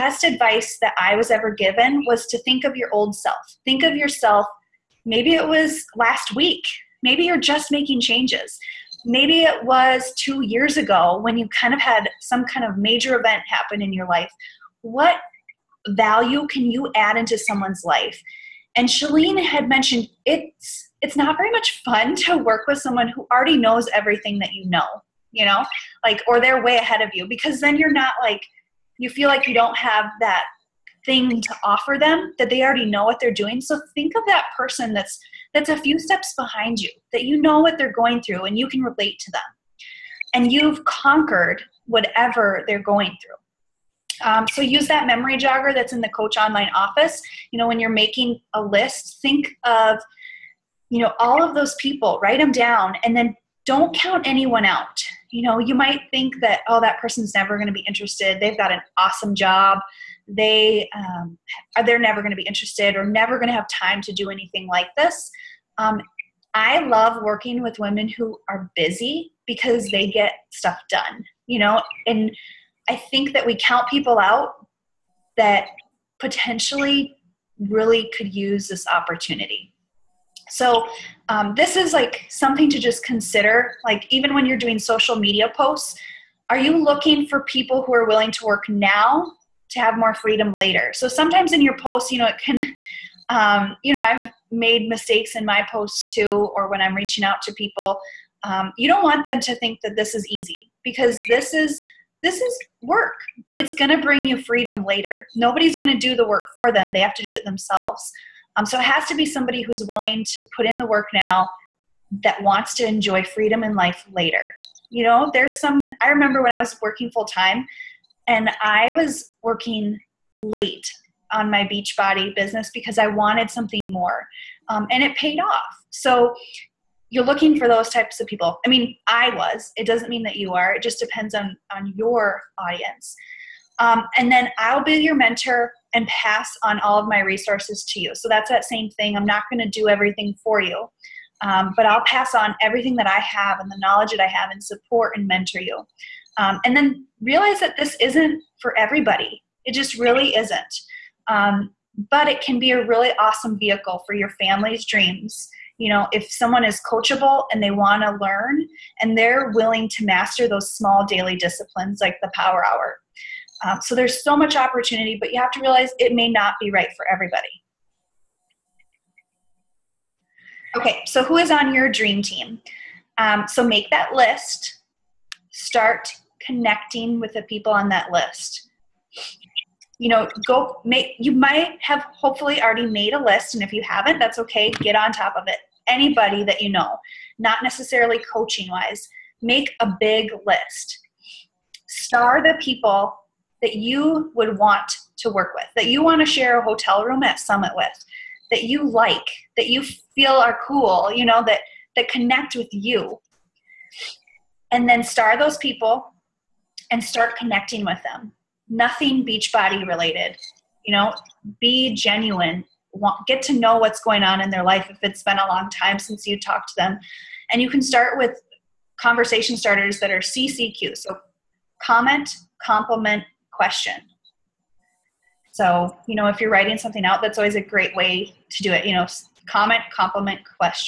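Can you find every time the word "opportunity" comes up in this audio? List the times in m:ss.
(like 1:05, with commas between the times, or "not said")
1:18, 2:44.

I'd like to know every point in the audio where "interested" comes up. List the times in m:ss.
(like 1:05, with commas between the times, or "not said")
0:57, 1:02.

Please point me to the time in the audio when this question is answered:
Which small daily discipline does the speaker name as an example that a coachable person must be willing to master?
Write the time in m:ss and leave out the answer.
2:42.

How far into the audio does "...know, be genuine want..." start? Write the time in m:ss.
3:30.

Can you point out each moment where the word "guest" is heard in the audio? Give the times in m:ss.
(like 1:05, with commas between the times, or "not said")
not said.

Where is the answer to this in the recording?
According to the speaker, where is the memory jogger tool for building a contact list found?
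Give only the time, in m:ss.
0:46.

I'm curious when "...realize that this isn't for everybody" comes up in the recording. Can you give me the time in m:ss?
2:27.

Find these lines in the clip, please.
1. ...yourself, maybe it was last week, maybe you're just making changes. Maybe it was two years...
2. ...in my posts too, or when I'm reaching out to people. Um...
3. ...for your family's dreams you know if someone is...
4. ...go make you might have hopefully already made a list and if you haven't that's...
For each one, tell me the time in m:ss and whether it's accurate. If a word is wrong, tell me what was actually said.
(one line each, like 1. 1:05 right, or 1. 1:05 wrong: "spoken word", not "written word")
1. 0:03 right
2. 1:35 right
3. 2:34 right
4. 3:00 right.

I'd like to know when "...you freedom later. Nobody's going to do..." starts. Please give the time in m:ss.
1:44.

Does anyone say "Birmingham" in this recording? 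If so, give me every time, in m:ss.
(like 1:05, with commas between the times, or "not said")
not said.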